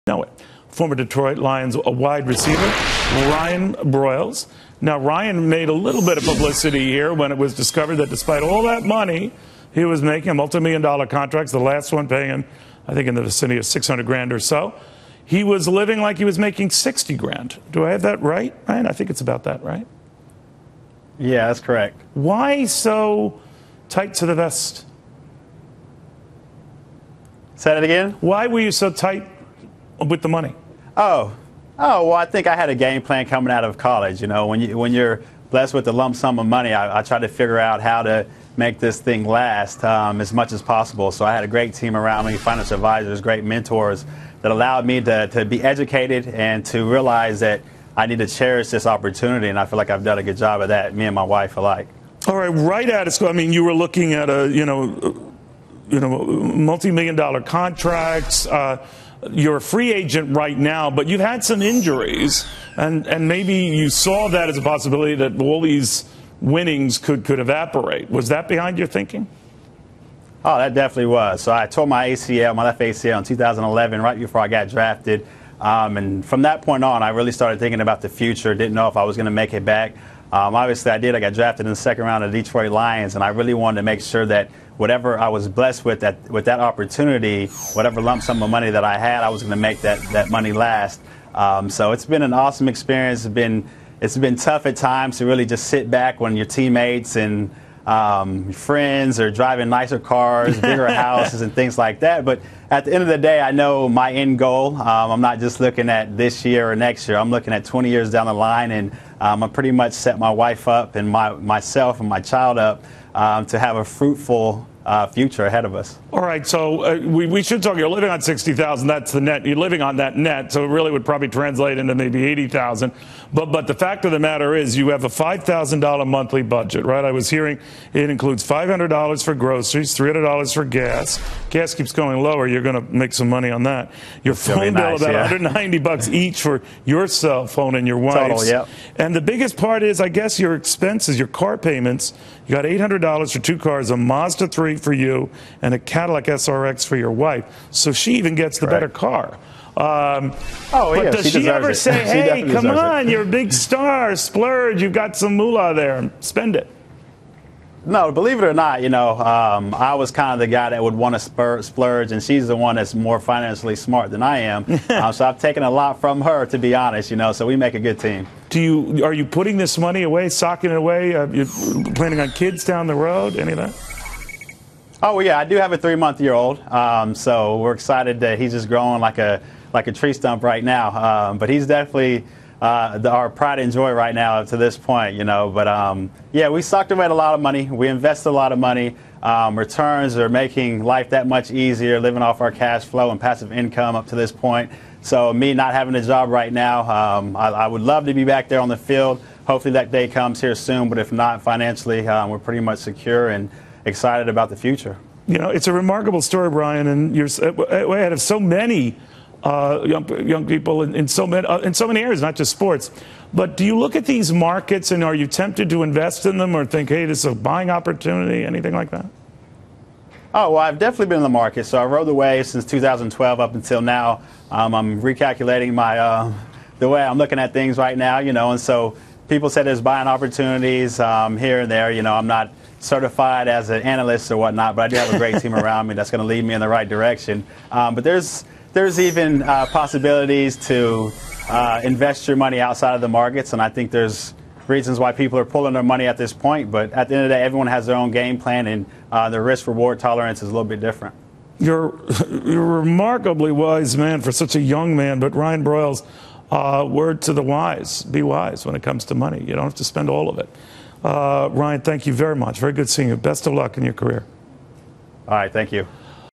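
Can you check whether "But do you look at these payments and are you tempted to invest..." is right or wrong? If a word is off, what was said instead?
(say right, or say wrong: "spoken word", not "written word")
wrong: "markets", not "payments".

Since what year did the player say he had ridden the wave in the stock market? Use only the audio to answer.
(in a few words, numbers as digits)
2012.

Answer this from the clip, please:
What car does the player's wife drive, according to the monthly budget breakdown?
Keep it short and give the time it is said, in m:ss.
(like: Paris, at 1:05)
Cadillac SRX, at 2:25.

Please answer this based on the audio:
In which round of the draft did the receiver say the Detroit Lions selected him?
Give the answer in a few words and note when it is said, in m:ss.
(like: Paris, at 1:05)
Second round, at 1:21.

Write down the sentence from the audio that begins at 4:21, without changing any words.
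Uh, Ryan, thank you very much.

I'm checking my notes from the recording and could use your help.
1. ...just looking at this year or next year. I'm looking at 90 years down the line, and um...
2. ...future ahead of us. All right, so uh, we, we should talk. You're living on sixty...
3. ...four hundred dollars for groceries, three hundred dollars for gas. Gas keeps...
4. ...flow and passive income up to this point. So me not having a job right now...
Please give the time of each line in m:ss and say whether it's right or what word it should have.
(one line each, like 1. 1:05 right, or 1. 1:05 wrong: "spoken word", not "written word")
1. 1:45 wrong: "20", not "90"
2. 1:55 right
3. 2:08 wrong: "five", not "four"
4. 3:12 right.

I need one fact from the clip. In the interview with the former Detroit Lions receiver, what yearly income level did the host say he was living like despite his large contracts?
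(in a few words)
60 grand.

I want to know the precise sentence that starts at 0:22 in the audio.
Why so tight to the vest?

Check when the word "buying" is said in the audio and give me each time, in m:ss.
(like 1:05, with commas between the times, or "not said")
3:37, 3:49.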